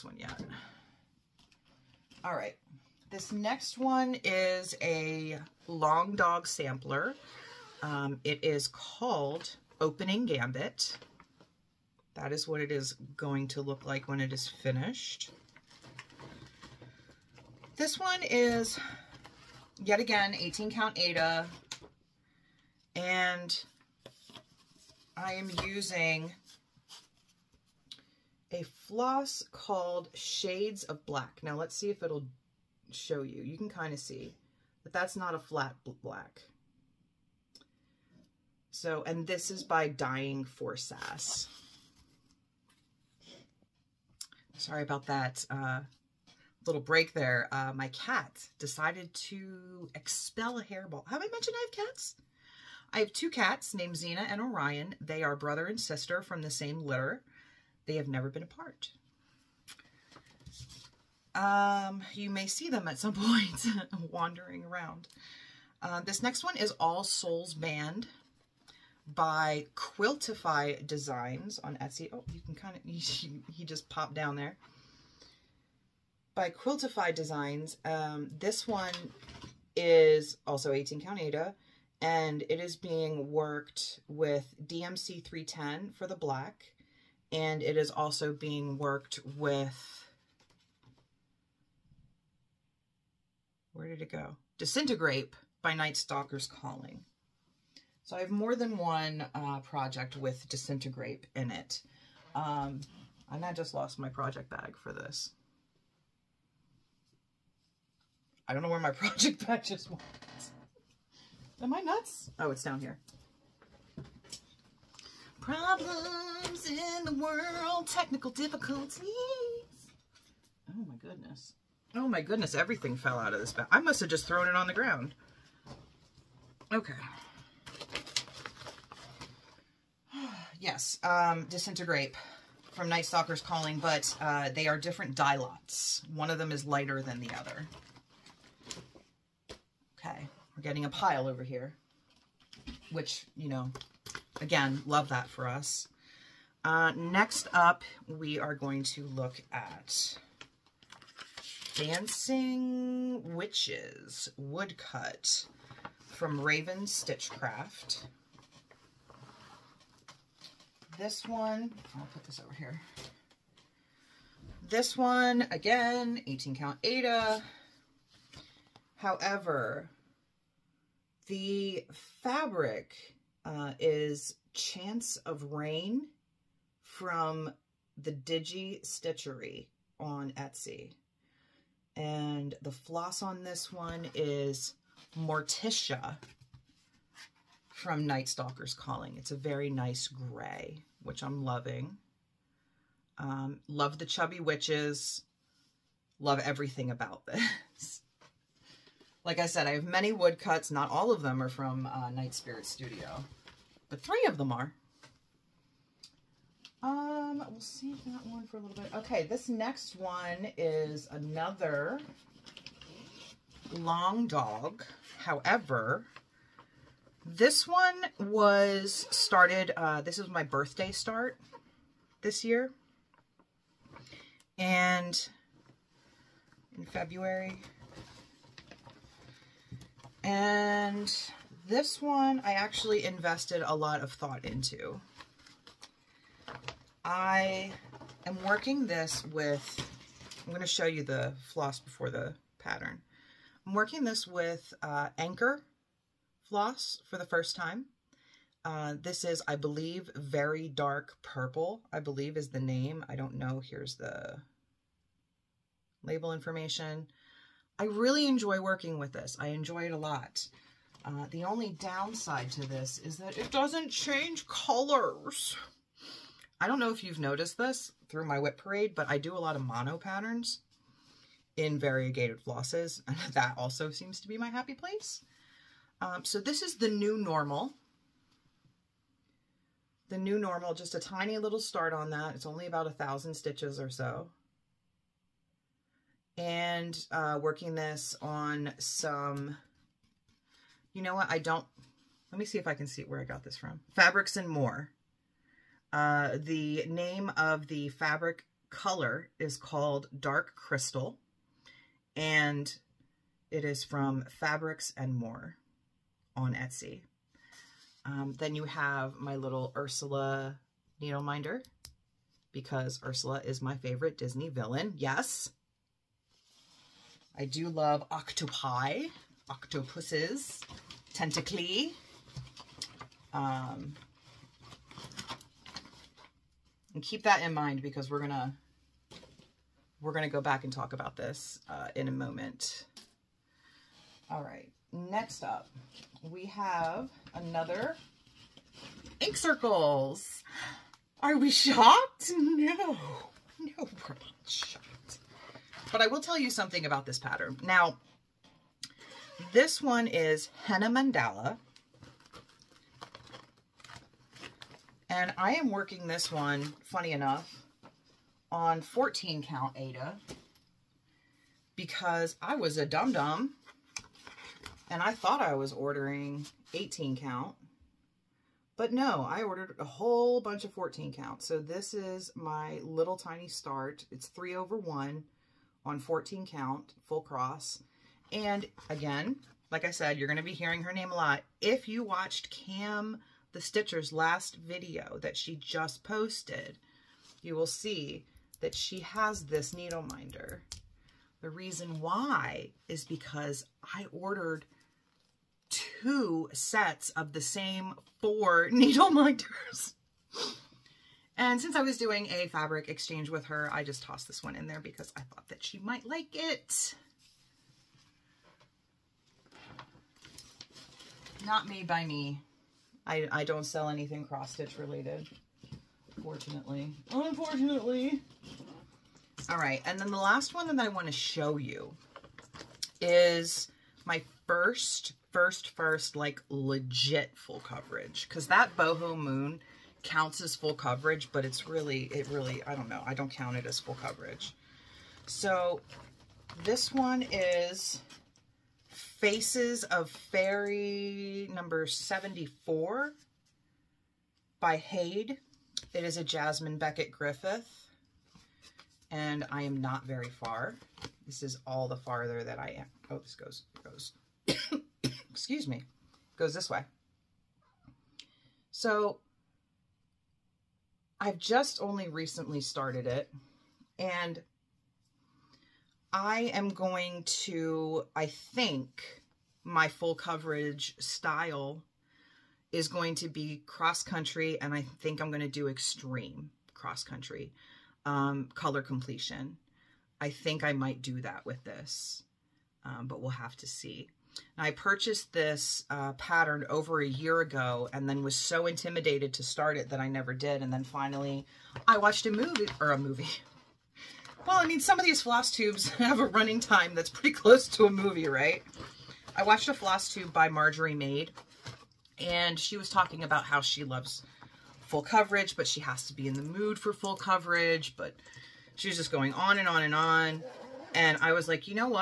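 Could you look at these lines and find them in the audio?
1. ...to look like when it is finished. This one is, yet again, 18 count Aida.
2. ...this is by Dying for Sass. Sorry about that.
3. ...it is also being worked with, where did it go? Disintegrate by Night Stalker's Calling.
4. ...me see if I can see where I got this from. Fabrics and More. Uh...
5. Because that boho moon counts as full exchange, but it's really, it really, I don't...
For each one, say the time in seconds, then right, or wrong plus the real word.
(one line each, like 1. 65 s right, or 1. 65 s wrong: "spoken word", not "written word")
1. 13 s right
2. 39 s right
3. 87 s right
4. 292 s right
5. 428 s wrong: "coverage", not "exchange".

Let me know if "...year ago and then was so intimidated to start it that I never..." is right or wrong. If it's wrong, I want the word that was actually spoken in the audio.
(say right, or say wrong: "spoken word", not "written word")
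right.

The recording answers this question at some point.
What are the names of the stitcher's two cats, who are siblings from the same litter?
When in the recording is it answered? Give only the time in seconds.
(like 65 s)
53 s.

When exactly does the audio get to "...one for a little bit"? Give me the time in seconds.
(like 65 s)
208 s.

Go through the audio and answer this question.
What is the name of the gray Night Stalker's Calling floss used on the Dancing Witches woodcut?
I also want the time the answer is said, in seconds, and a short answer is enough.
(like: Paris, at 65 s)
Morticia, at 185 s.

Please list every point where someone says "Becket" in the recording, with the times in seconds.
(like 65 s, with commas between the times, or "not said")
446 s.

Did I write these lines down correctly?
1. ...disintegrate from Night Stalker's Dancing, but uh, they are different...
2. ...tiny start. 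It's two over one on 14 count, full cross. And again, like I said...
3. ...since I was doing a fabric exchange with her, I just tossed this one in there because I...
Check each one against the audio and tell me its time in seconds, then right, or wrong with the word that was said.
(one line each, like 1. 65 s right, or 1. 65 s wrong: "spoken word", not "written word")
1. 131 s wrong: "Calling", not "Dancing"
2. 373 s wrong: "three", not "two"
3. 401 s right.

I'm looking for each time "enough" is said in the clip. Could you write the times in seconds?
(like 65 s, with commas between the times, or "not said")
357 s.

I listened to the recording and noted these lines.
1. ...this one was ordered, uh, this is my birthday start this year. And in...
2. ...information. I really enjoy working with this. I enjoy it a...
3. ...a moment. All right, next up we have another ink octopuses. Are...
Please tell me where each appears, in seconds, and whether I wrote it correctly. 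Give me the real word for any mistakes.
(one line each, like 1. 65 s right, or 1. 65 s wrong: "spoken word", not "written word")
1. 217 s wrong: "started", not "ordered"
2. 256 s right
3. 332 s wrong: "circles", not "octopuses".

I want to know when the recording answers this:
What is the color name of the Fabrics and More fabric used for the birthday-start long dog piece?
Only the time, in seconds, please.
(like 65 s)
300 s.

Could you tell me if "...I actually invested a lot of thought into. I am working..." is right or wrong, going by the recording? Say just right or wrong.
right.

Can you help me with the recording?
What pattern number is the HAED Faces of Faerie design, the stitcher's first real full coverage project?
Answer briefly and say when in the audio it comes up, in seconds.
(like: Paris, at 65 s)
74, at 441 s.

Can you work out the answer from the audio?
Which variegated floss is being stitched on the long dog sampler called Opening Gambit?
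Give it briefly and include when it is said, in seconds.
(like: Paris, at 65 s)
Shades of Black, at 30 s.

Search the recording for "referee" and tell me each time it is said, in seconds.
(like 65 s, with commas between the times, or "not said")
not said.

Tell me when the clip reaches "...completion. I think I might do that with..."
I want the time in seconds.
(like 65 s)
478 s.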